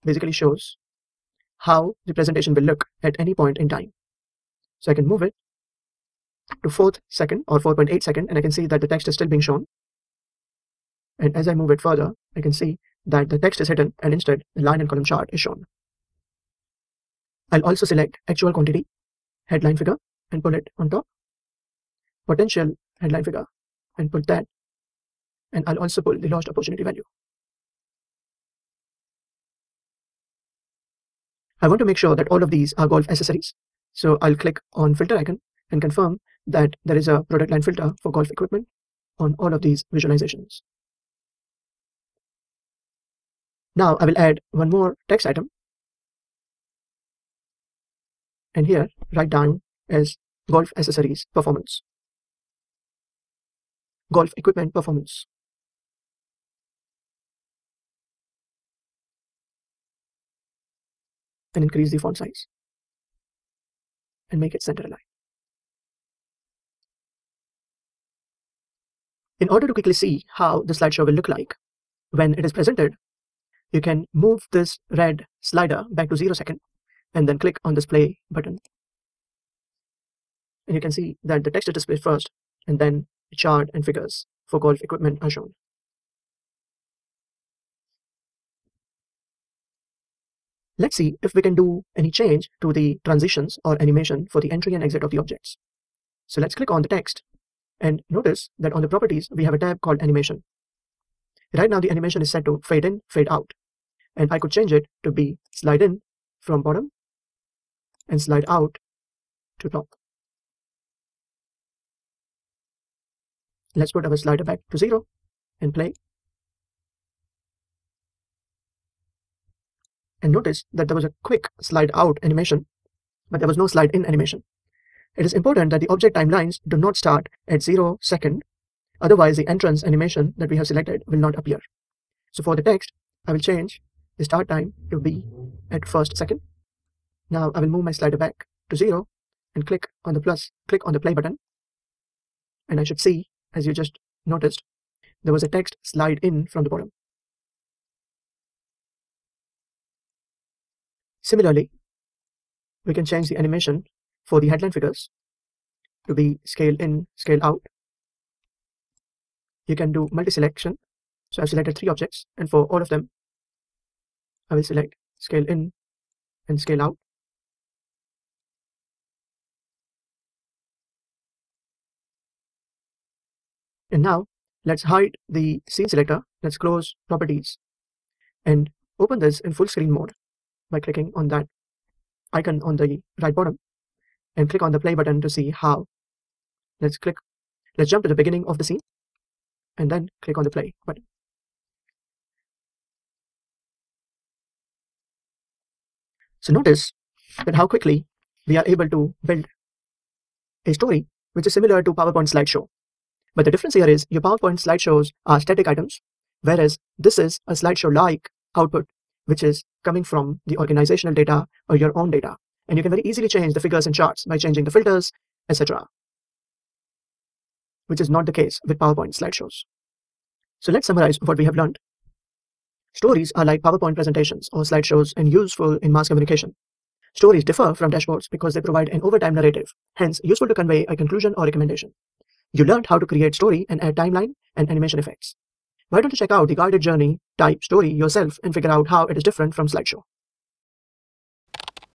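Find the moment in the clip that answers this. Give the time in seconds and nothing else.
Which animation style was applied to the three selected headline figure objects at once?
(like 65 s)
156 s.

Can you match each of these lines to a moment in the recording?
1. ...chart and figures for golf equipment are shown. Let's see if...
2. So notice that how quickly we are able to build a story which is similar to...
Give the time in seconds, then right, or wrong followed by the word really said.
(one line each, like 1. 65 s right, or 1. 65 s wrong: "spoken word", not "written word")
1. 83 s right
2. 196 s right.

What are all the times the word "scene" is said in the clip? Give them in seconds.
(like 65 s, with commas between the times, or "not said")
175 s, 188 s.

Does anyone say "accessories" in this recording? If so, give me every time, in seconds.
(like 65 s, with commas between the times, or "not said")
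33 s, 50 s.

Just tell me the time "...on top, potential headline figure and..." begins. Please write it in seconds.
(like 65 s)
20 s.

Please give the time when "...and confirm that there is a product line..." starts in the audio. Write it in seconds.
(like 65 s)
35 s.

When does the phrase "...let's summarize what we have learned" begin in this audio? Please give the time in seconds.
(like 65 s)
220 s.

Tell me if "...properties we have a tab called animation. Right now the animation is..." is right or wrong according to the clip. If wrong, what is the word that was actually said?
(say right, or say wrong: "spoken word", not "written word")
right.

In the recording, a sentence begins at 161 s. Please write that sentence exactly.
So I've selected three objects and for all of them, I will select scale in and scale out.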